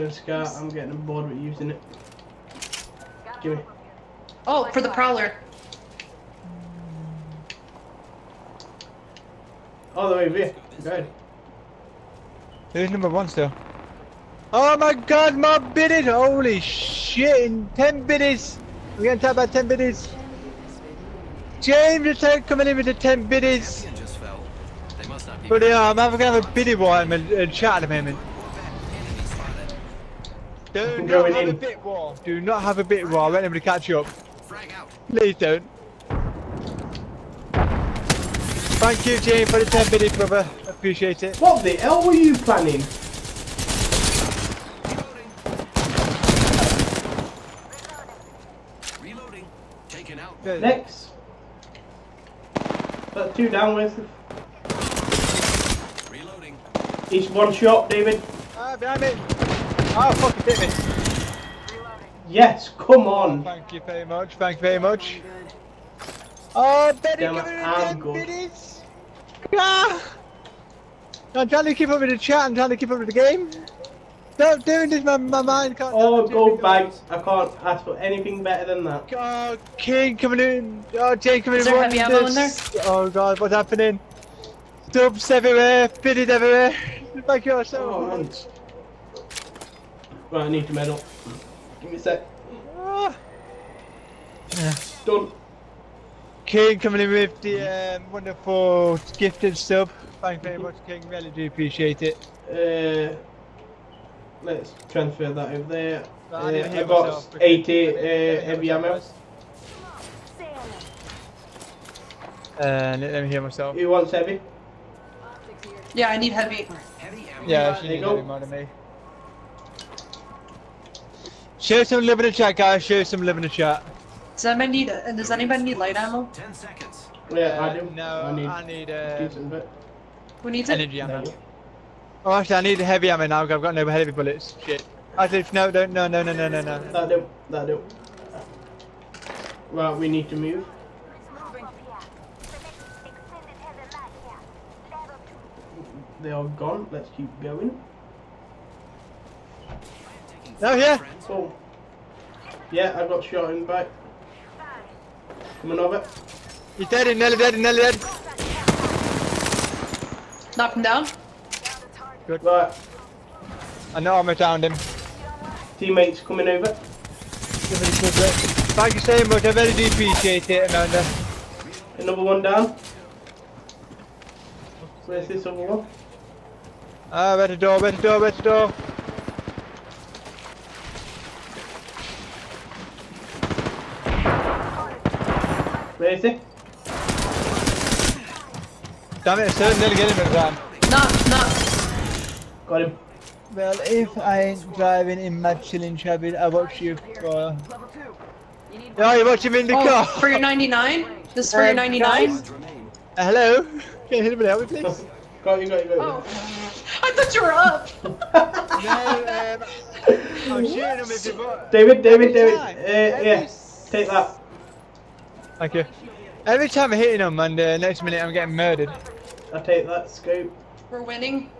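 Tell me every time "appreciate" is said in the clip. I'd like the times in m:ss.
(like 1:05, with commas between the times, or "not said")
0:40, 1:41, 2:49.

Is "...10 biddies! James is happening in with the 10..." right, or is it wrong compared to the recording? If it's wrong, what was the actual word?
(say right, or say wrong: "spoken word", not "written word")
wrong: "coming", not "happening".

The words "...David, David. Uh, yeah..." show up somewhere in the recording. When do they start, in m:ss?
3:32.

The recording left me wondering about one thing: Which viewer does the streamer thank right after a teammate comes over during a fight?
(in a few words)
Amanda.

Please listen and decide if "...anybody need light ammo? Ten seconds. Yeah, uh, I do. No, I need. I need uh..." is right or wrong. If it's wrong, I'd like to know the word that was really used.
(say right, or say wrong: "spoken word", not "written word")
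right.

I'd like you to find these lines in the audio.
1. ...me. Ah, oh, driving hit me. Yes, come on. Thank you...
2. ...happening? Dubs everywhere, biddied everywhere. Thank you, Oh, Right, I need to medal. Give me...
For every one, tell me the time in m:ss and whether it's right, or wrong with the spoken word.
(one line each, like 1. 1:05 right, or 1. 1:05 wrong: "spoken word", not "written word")
1. 0:59 wrong: "fucking", not "driving"
2. 1:23 right.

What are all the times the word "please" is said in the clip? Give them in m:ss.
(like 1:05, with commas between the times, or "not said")
0:35, 3:24.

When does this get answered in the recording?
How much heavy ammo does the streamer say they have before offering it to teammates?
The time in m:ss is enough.
1:47.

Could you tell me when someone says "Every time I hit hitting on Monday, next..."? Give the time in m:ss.
3:36.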